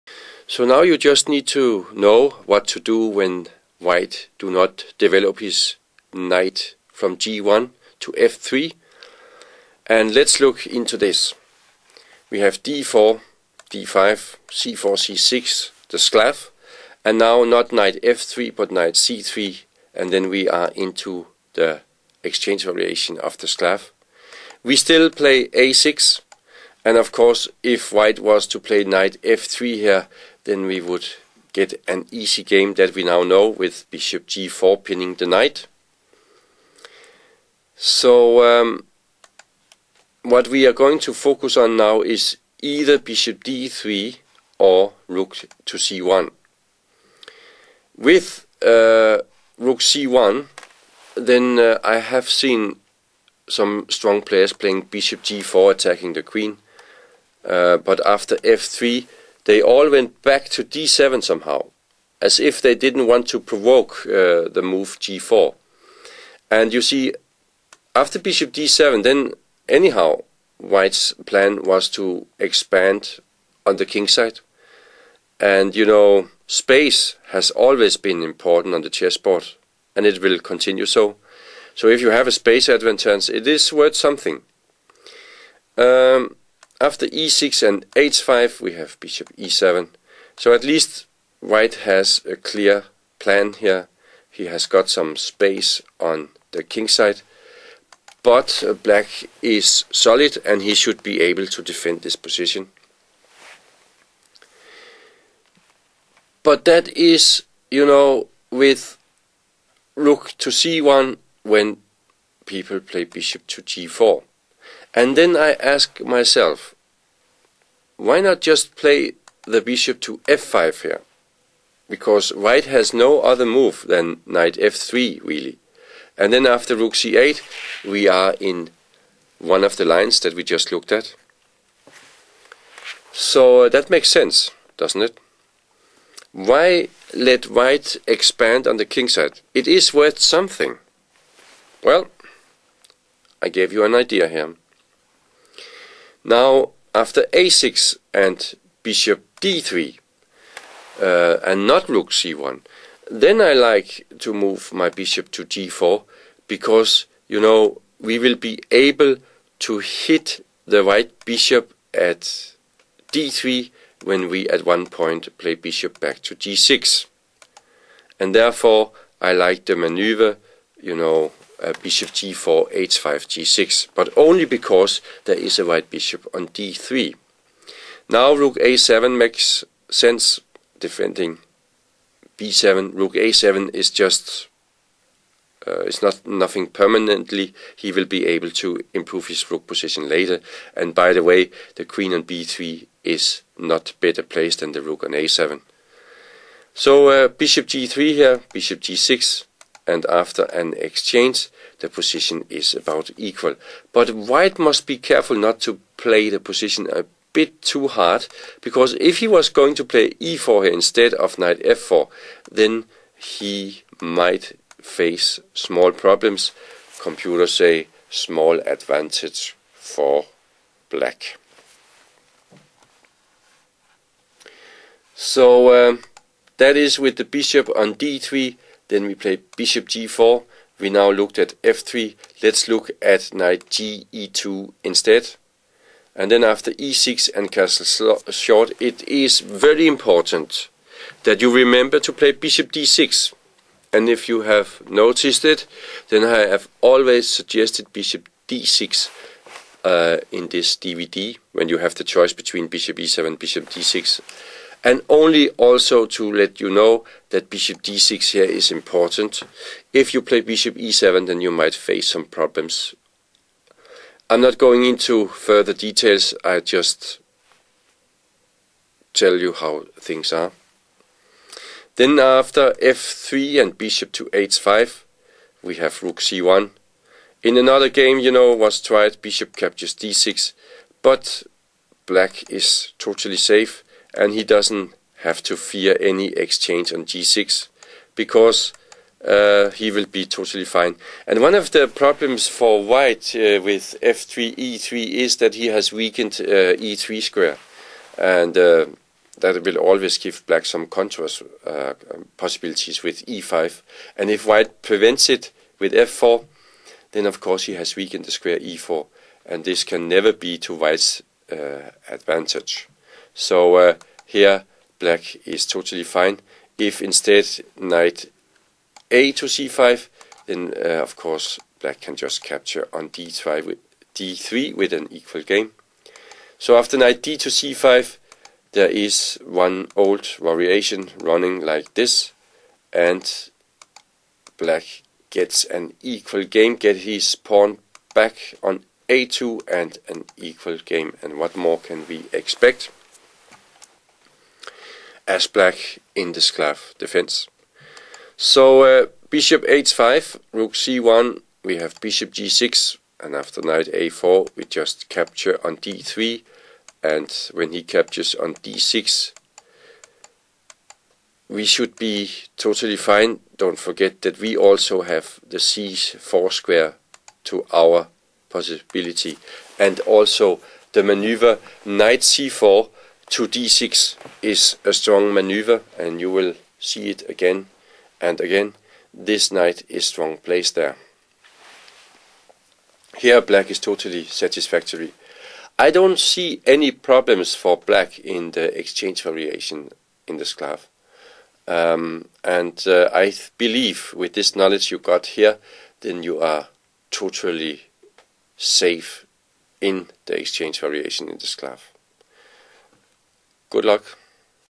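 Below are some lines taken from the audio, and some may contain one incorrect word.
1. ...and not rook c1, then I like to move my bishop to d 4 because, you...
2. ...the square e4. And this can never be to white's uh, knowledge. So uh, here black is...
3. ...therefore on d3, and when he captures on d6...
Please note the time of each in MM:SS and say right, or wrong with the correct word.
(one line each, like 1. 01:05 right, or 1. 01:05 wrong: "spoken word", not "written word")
1. 02:31 right
2. 05:08 wrong: "advantage", not "knowledge"
3. 05:55 wrong: "capture", not "therefore".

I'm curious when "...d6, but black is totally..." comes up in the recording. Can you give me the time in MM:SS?
04:39.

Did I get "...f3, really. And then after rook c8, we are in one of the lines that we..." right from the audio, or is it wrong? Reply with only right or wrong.
right.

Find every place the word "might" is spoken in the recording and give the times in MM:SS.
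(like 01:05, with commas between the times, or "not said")
03:34, 04:21.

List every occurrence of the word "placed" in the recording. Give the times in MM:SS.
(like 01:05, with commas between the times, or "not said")
03:14, 06:20.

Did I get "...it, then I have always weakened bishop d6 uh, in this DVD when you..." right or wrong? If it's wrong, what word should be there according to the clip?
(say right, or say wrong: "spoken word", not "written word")
wrong: "suggested", not "weakened".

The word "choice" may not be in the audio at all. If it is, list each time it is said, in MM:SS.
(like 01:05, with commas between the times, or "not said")
04:12.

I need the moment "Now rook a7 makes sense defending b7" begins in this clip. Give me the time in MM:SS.
02:58.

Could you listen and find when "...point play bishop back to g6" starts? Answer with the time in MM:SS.
02:44.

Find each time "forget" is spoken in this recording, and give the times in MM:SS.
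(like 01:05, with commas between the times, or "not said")
06:03.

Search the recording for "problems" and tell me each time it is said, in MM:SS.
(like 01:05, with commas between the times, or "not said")
03:35, 04:22, 04:51, 06:26.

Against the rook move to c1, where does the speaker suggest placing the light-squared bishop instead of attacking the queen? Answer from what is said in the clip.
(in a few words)
f5.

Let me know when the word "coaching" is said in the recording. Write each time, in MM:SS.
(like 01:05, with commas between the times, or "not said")
not said.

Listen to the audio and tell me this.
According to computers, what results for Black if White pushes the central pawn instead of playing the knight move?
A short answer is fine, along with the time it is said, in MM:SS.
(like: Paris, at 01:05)
Small advantage for black, at 03:38.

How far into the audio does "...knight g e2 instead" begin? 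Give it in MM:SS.
03:53.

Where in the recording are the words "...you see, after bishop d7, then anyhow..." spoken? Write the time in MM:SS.
01:06.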